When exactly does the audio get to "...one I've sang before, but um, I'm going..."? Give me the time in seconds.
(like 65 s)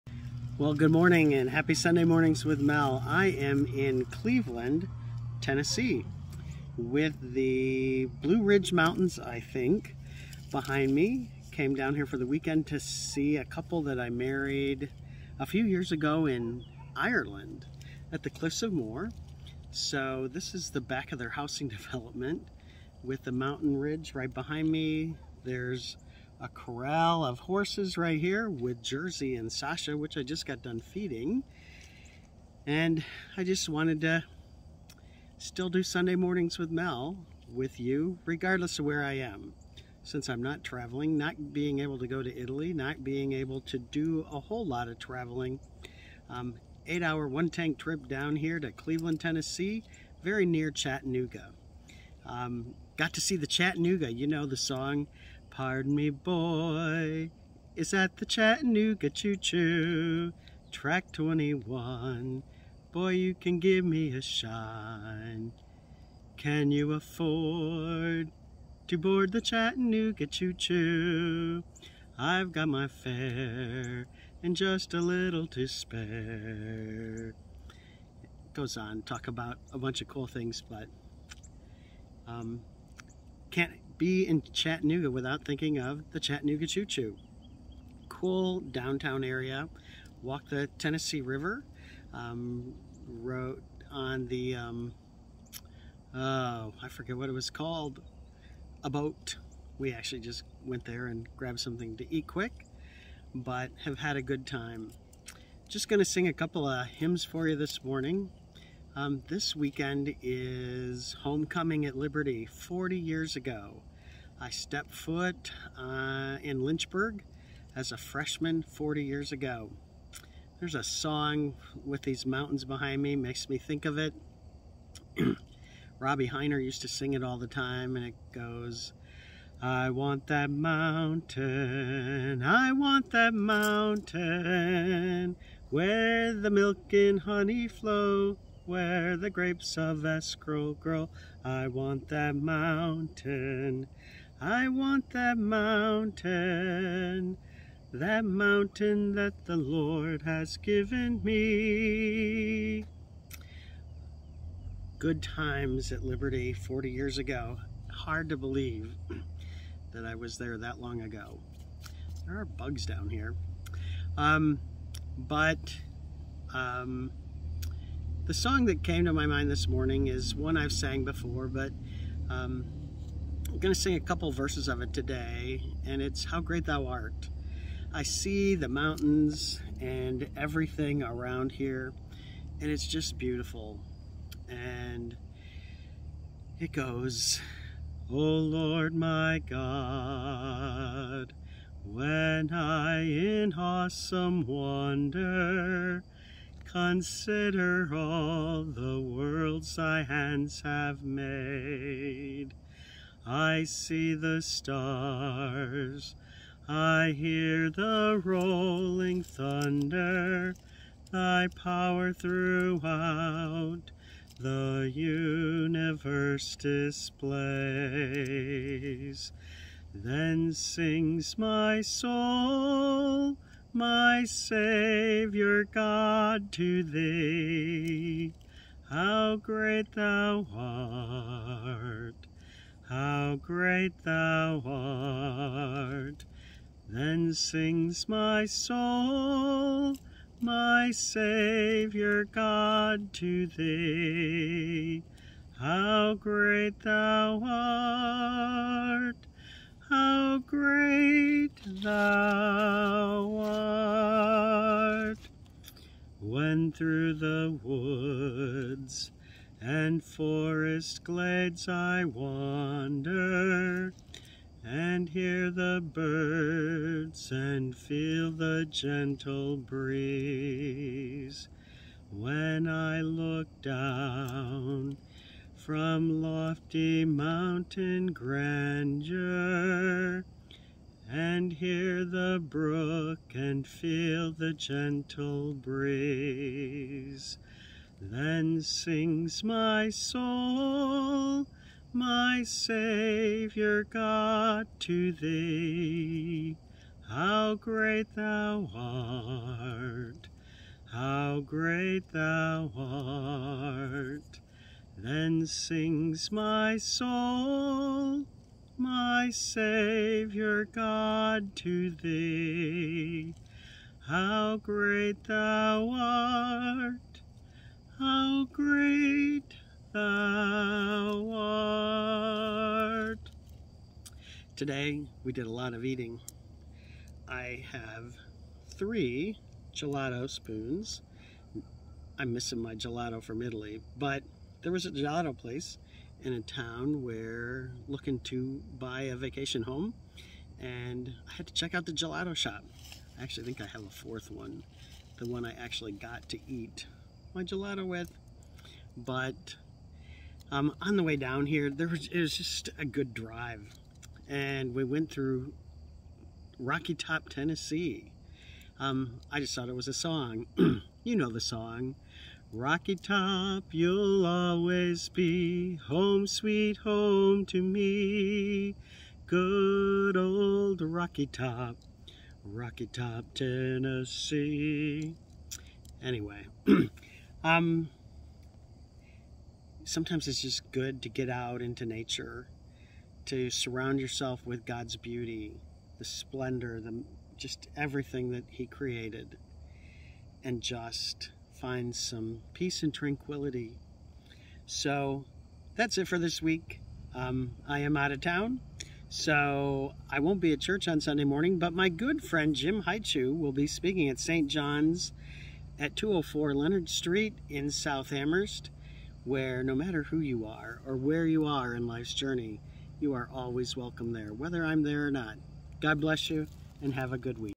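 170 s.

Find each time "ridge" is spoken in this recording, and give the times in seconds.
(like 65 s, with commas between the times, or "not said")
8 s, 23 s.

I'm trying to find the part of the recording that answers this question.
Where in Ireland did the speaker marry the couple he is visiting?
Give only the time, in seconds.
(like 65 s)
18 s.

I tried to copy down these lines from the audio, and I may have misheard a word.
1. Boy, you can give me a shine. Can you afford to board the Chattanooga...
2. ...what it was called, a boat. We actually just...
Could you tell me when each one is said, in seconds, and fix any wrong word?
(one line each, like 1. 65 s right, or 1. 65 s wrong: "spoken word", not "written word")
1. 62 s right
2. 97 s right.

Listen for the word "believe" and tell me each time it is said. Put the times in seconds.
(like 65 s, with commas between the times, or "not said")
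158 s.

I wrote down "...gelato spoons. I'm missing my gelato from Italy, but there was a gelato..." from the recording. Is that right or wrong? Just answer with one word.
right.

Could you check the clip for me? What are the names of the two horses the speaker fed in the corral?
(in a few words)
Jersey and Sasha.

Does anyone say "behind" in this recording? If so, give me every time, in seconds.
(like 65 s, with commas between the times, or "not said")
10 s, 24 s, 122 s.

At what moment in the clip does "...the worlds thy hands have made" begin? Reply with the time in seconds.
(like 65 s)
198 s.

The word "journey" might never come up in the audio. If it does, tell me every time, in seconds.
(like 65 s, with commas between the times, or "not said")
412 s.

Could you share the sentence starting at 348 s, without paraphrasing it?
But um, on the way down here, there was it was just a good drive, and we went through Rocky Top, Tennessee.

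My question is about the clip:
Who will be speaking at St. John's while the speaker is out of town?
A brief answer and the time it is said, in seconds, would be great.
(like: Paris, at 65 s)
Jim Haichu, at 402 s.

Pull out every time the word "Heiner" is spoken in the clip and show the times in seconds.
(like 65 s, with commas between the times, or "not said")
126 s.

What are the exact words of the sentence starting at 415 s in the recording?
God bless you and have a good week.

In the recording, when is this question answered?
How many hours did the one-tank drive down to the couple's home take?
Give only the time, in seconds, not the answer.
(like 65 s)
46 s.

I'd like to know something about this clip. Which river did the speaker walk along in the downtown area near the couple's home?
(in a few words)
Tennessee River.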